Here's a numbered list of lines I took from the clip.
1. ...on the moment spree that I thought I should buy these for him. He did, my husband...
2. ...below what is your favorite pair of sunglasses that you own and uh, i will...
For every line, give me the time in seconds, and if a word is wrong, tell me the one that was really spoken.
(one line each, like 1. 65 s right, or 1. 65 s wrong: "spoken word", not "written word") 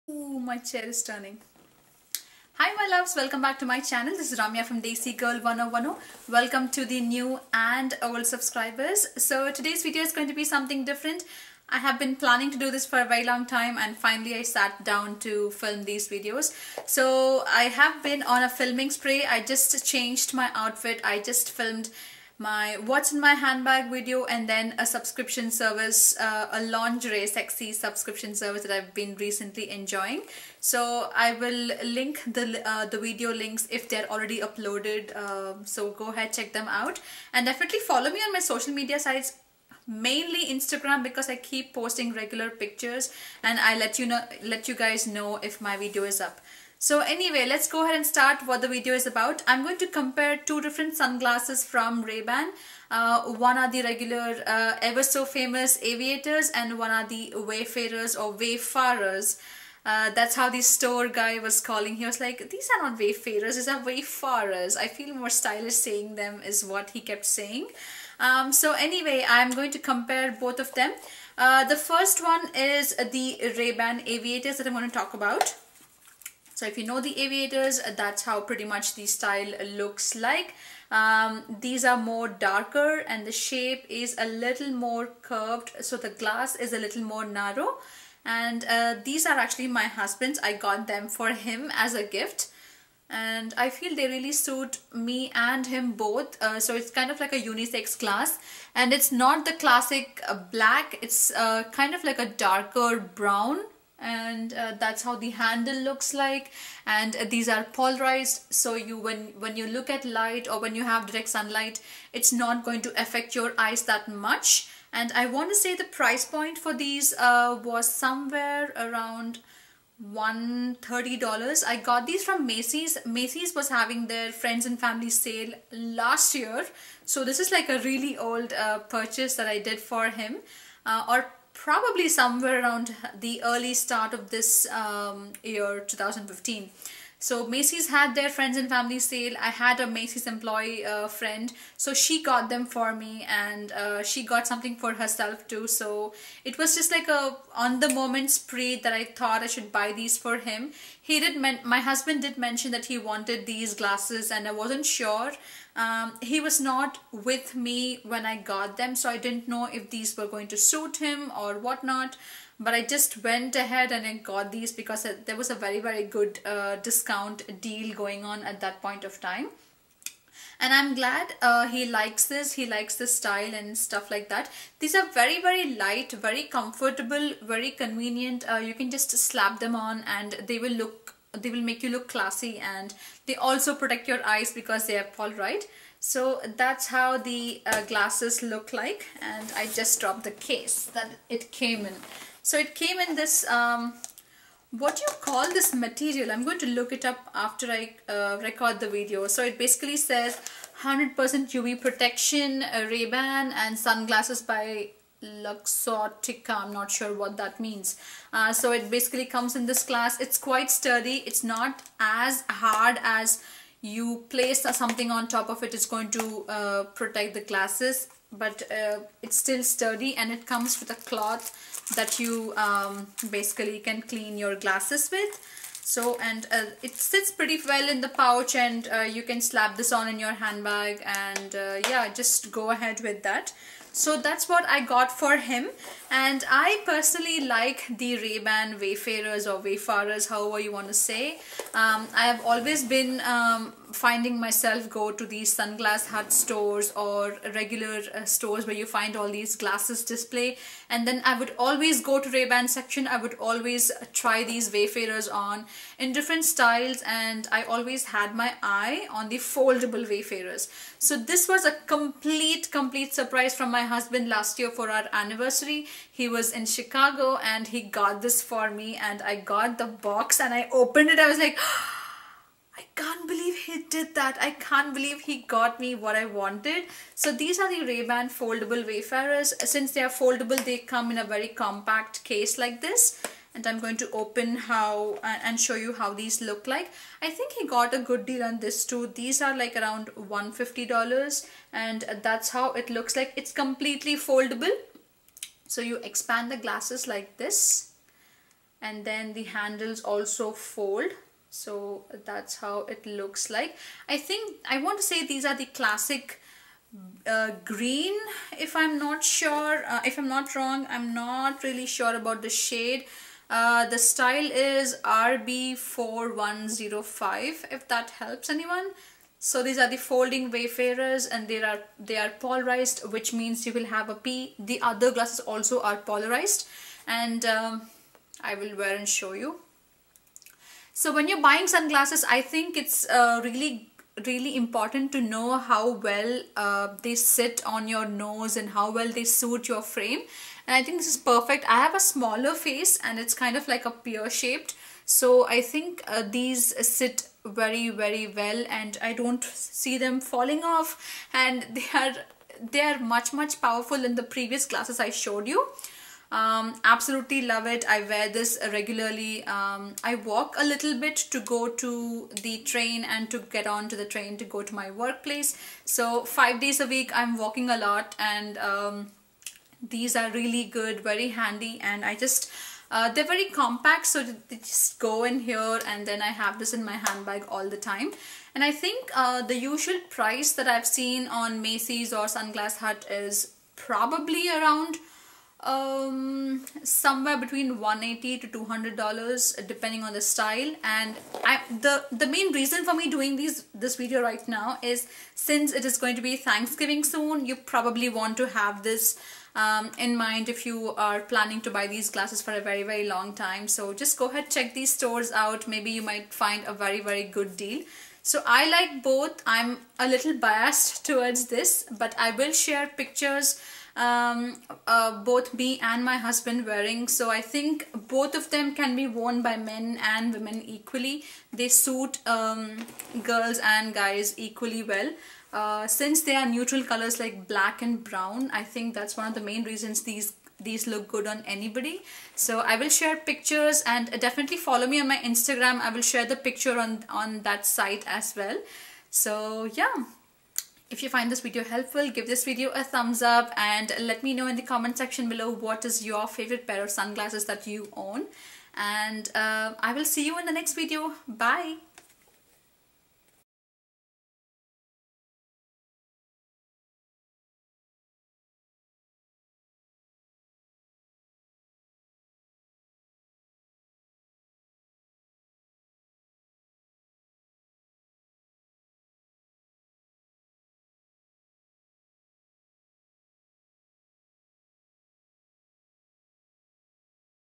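1. 147 s right
2. 445 s right.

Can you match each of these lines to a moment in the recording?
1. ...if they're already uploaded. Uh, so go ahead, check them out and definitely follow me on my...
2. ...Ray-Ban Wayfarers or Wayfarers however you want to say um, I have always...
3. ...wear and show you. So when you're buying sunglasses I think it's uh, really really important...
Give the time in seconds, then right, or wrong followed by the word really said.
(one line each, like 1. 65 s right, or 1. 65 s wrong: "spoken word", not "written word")
1. 33 s right
2. 238 s right
3. 328 s right.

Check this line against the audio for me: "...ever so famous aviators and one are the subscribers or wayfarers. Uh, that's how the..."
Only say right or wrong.
wrong.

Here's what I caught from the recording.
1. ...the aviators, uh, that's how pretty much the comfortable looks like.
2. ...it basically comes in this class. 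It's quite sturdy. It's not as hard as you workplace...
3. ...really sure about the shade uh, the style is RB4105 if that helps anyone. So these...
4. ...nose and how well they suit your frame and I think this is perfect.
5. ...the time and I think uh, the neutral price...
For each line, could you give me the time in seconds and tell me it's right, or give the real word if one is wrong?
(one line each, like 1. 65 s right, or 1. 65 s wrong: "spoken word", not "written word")
1. 77 s wrong: "style", not "comfortable"
2. 208 s wrong: "place", not "workplace"
3. 311 s right
4. 338 s right
5. 377 s wrong: "usual", not "neutral".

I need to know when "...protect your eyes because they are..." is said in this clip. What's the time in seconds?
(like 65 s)
183 s.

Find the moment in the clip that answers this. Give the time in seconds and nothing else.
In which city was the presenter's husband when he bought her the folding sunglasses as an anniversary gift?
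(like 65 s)
266 s.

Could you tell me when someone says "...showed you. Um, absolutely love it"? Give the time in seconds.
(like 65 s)
355 s.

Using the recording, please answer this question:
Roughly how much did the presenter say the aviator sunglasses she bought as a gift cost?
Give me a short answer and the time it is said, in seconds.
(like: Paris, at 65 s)
$130, at 120 s.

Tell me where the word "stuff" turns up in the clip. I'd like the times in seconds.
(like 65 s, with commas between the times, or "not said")
173 s.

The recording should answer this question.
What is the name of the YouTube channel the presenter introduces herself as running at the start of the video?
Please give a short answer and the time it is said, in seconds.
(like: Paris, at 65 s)
Desi Gal 1010, at 4 s.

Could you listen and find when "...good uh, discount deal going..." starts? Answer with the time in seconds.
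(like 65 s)
166 s.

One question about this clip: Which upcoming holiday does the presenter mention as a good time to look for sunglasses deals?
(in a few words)
Thanksgiving.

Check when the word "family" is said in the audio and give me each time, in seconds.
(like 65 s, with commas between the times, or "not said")
124 s, 138 s.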